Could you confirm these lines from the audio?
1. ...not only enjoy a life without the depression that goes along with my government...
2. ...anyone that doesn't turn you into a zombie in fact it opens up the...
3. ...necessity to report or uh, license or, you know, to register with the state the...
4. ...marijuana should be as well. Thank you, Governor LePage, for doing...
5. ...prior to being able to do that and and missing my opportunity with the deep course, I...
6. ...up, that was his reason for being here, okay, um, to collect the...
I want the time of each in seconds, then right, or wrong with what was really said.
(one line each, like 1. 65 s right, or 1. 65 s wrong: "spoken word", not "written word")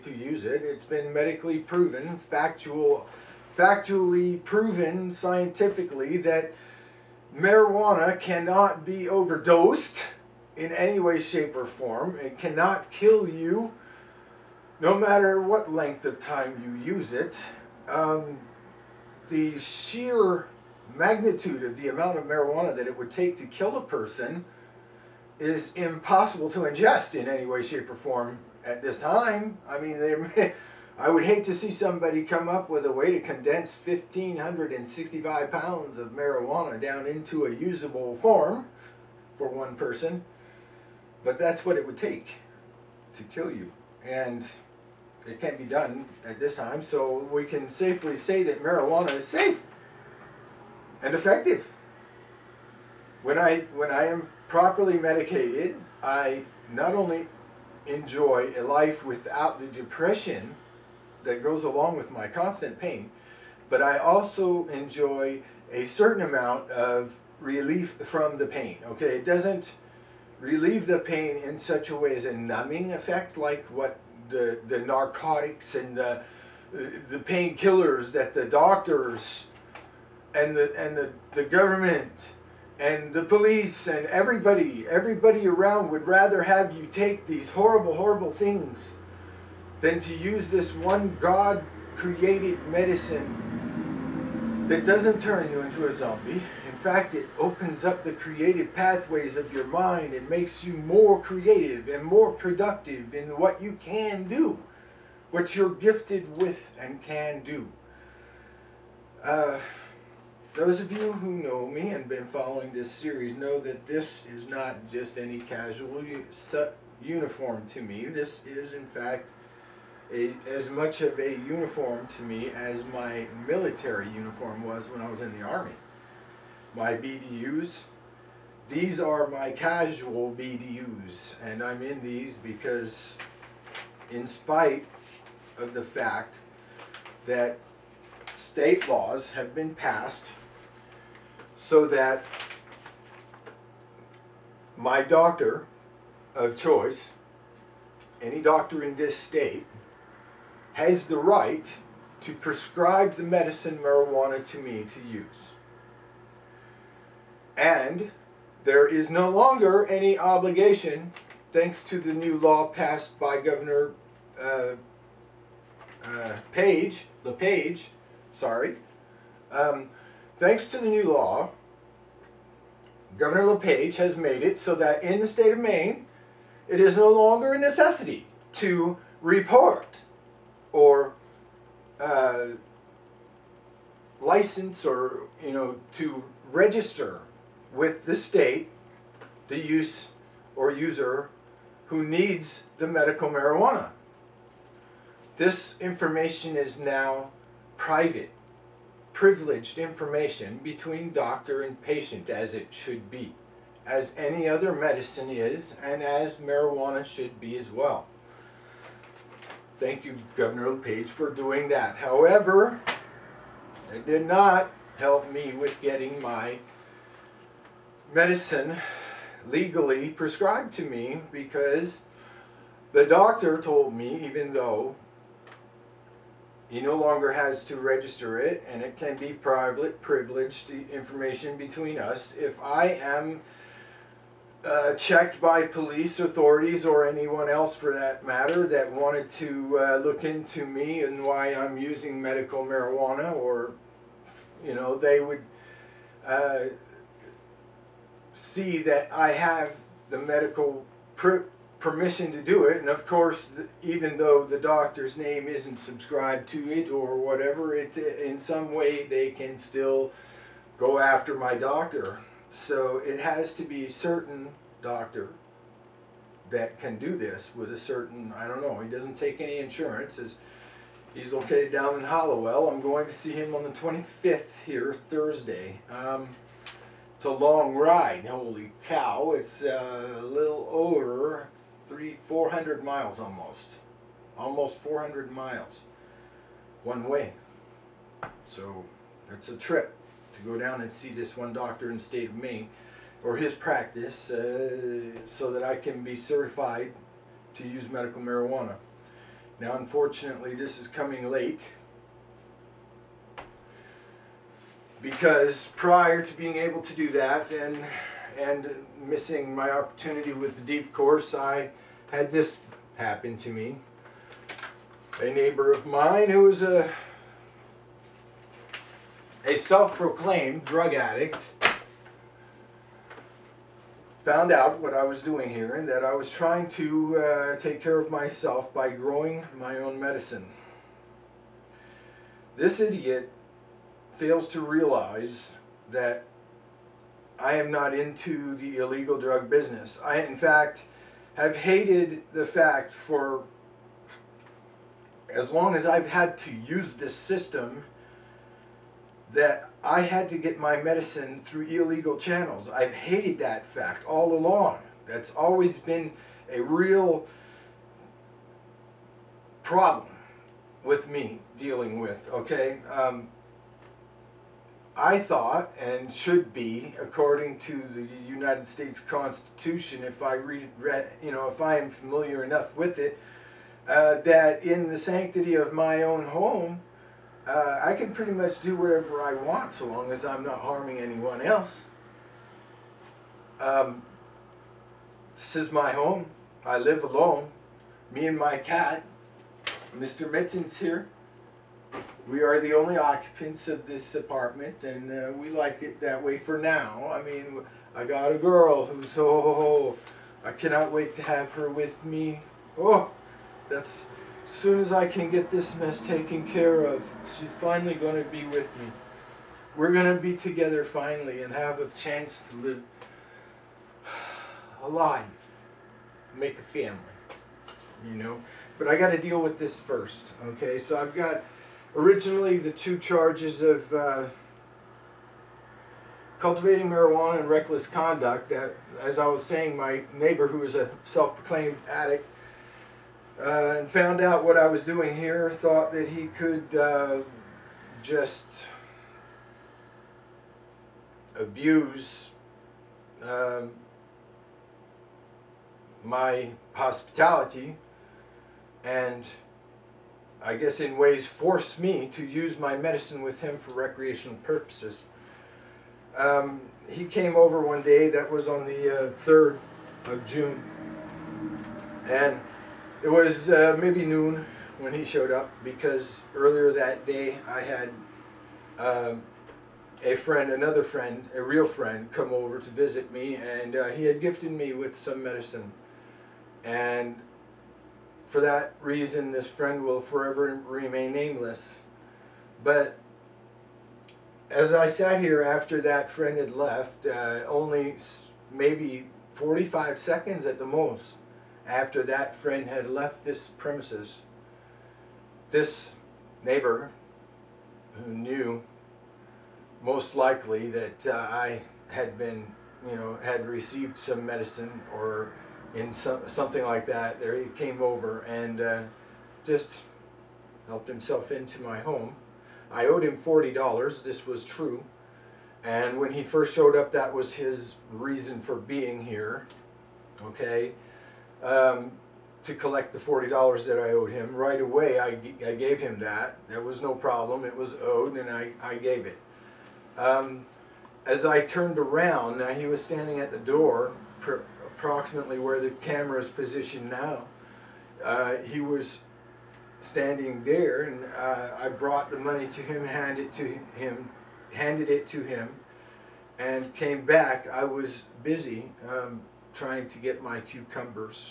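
1. 56 s wrong: "constant", not "government"
2. 92 s wrong: "medicine", not "anyone"
3. 177 s right
4. 206 s right
5. 305 s right
6. 516 s right.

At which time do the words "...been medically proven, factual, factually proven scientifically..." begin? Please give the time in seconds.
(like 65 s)
0 s.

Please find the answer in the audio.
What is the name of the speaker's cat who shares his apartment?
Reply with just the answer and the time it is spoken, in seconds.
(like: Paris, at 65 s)
Mr. Mittens, at 389 s.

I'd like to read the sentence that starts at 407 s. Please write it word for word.
She's finally going to be with me.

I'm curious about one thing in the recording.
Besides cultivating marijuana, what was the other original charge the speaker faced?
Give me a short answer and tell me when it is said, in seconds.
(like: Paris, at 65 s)
reckless conduct, at 427 s.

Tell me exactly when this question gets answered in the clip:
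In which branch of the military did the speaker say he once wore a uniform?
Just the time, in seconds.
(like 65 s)
125 s.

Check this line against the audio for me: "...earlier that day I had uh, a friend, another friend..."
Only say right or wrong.
right.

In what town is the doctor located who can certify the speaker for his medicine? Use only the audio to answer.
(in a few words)
Hallowell.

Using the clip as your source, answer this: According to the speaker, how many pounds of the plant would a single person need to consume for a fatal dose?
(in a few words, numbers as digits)
1,565 pounds.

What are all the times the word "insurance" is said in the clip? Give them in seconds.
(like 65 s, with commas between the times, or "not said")
269 s.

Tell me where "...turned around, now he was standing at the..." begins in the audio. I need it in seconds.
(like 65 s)
531 s.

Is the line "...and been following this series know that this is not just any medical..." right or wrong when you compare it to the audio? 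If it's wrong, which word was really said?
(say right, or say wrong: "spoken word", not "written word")
wrong: "casual", not "medical".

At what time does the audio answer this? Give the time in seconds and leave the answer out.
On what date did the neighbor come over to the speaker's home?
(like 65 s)
459 s.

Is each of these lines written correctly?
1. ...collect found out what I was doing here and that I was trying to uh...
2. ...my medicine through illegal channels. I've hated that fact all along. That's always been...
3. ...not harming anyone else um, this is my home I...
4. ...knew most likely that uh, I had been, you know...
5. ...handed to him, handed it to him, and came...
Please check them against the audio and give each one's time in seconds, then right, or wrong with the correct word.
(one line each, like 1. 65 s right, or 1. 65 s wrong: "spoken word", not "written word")
1. 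320 s wrong: "addict", not "collect"
2. 350 s right
3. 380 s right
4. 498 s right
5. 542 s right.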